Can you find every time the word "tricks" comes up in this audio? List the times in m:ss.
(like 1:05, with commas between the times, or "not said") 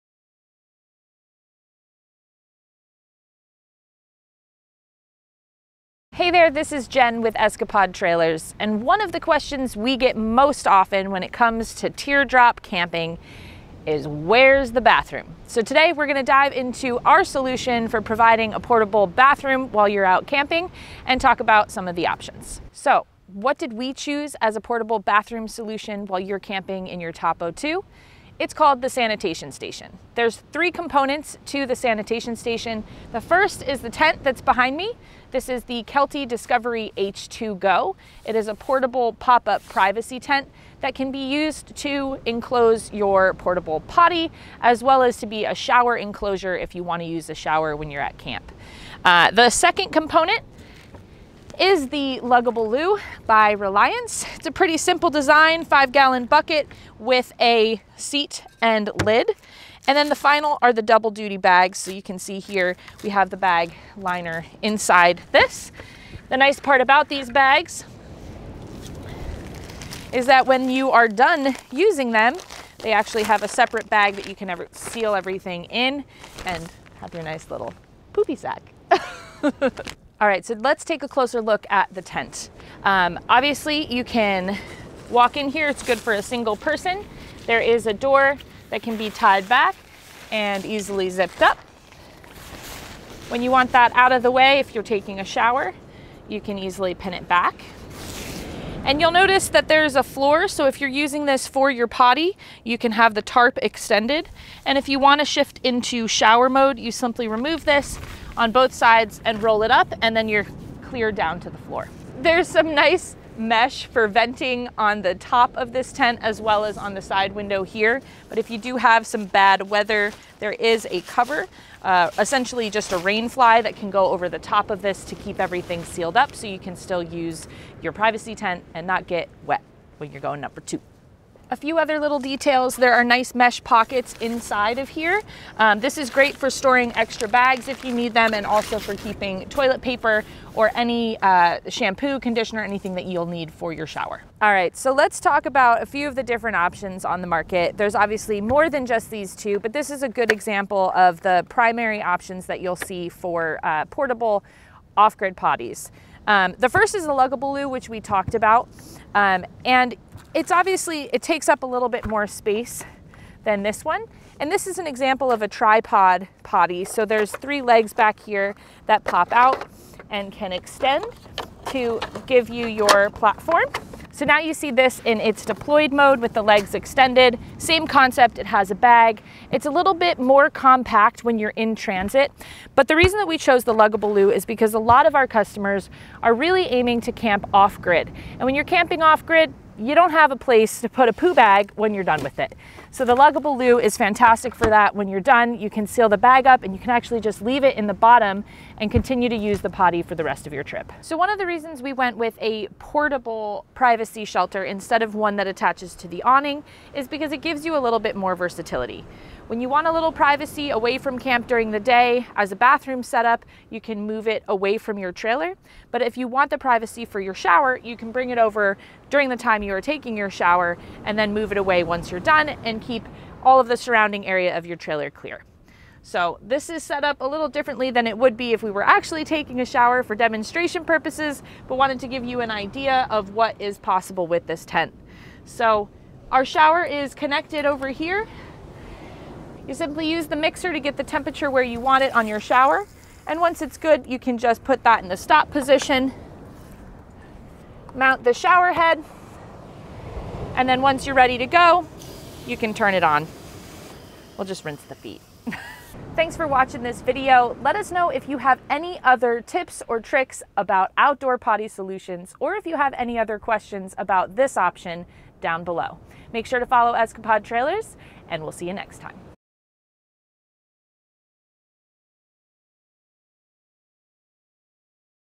4:20.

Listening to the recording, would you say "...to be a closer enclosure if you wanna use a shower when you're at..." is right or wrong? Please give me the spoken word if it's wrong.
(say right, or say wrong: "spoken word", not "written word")
wrong: "shower", not "closer".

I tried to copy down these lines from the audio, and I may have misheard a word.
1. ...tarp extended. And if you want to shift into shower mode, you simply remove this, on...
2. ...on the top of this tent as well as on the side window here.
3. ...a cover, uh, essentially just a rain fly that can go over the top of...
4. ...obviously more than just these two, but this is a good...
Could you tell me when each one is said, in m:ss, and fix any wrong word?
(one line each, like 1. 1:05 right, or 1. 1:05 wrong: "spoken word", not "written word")
1. 1:43 right
2. 1:54 right
3. 2:00 right
4. 2:27 right.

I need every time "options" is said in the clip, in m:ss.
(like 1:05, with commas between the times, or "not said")
0:22, 2:26, 2:32, 4:24.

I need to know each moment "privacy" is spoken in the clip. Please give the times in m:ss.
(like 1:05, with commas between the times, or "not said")
0:39, 2:07, 3:23, 3:30, 3:36.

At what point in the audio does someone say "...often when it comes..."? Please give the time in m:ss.
0:10.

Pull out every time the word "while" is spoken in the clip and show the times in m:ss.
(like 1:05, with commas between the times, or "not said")
0:19, 0:26.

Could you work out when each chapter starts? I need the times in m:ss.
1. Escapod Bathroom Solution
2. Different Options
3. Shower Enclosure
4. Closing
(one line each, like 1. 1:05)
1. 0:15
2. 2:24
3. 3:21
4. 4:16.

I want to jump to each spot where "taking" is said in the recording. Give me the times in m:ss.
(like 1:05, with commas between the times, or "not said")
1:34, 3:39, 3:49.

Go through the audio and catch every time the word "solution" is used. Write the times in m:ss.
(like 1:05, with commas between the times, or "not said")
0:17, 0:25, 4:21.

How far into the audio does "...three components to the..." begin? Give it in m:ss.
0:30.